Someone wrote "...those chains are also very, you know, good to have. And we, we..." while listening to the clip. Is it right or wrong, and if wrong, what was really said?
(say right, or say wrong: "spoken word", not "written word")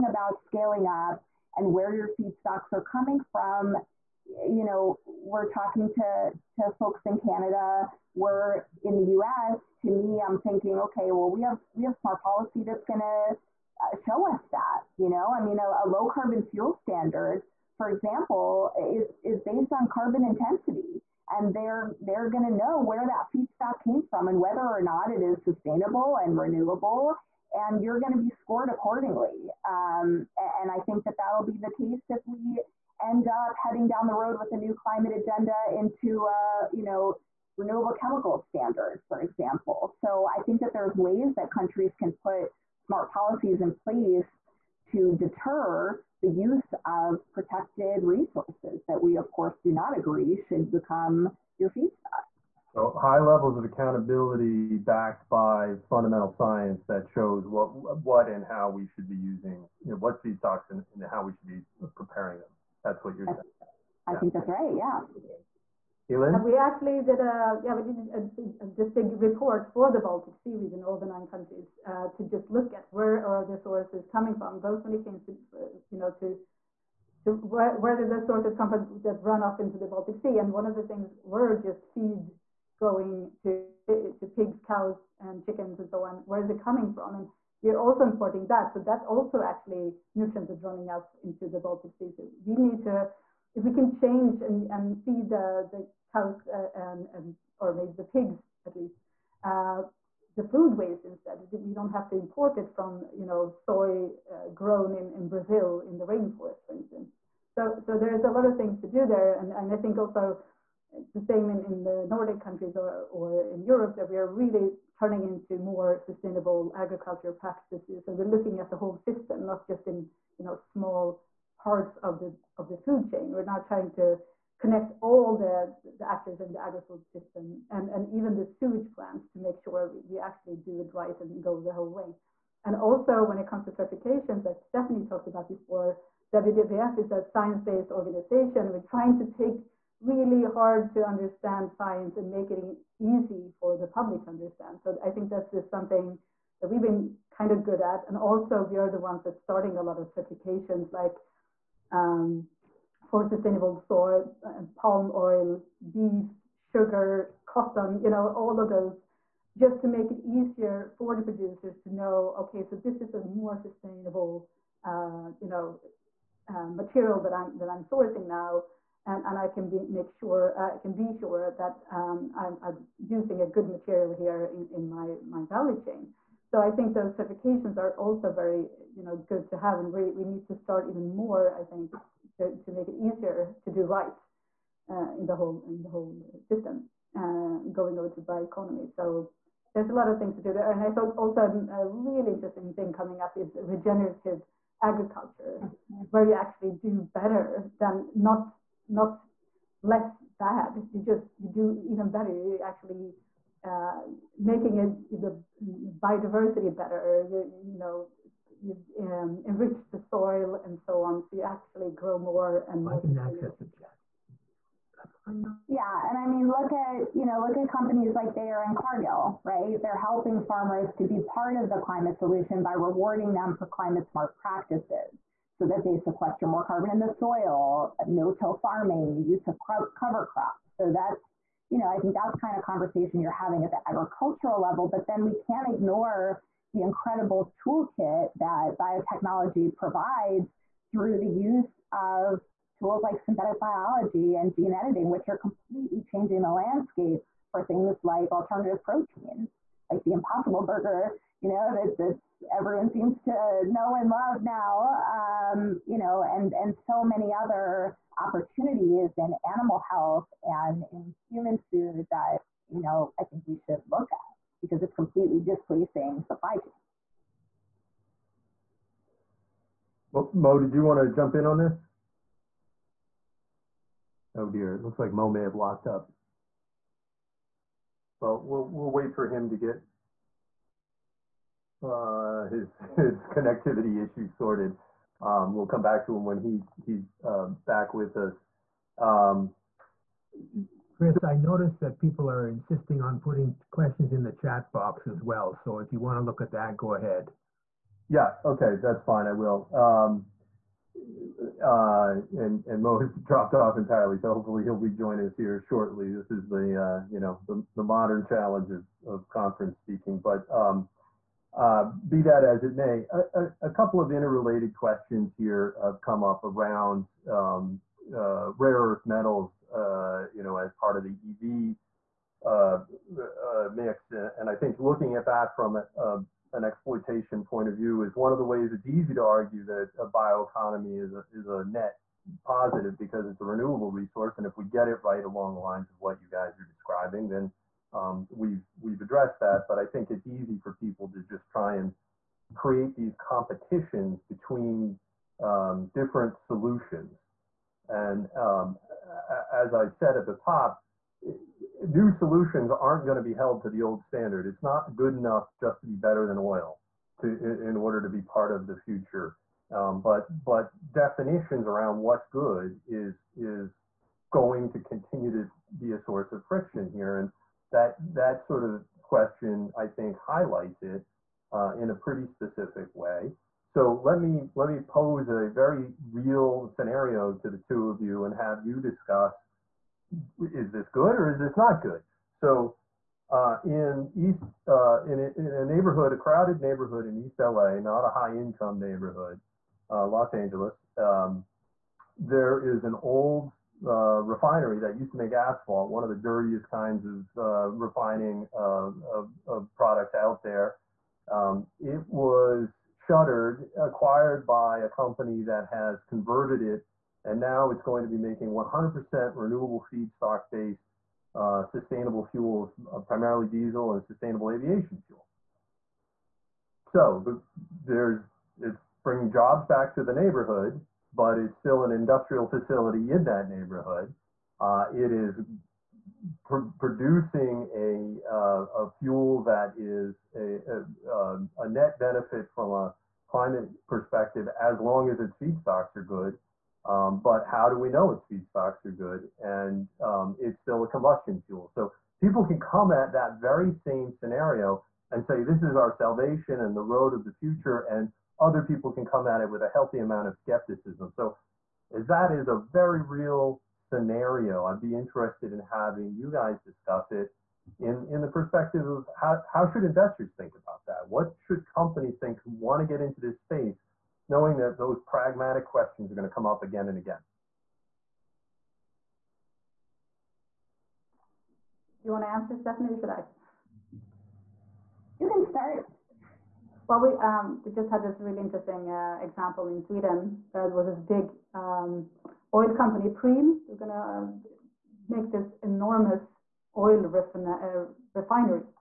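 wrong: "certifications", not "chains".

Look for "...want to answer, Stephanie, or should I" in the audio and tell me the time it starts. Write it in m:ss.
7:52.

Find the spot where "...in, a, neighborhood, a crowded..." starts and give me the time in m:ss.
6:25.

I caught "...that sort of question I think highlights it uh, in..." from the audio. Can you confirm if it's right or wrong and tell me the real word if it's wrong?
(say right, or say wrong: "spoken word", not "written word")
right.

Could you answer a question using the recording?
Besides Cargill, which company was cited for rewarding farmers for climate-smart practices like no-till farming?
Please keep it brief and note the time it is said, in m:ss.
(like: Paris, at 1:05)
Bayer, at 3:38.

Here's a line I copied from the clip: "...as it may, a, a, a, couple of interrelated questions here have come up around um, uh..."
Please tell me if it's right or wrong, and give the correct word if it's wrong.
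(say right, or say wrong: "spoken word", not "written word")
right.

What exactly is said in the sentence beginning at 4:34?
Oh dear, it looks like Mo may have locked up.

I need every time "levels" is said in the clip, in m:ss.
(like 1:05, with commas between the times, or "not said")
0:53, 3:54.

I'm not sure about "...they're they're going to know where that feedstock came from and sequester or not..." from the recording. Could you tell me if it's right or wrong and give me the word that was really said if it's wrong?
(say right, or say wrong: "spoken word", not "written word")
wrong: "whether", not "sequester".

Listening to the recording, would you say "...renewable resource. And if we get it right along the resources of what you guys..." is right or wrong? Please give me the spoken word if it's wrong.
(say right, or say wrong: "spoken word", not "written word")
wrong: "lines", not "resources".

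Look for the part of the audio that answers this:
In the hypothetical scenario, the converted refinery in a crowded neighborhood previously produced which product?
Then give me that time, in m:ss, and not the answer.
6:35.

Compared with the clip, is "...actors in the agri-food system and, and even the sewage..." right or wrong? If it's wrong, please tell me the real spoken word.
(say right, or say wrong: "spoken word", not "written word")
right.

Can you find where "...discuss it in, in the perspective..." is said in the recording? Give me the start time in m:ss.
7:36.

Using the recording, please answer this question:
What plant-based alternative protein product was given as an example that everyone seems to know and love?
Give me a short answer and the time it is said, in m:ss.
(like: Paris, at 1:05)
Impossible Burger, at 4:10.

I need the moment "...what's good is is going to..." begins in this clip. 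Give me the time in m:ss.
6:01.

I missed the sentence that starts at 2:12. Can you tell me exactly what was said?
And also when it comes to certifications that Stephanie talked about before, WWF is a science-based organization.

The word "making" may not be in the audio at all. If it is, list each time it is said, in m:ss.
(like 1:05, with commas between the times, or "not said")
3:24, 6:48.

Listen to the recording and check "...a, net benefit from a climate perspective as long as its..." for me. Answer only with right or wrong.
right.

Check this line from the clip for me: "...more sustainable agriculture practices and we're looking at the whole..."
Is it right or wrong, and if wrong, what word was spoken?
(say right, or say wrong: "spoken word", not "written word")
right.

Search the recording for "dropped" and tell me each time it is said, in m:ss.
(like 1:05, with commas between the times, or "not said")
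5:03.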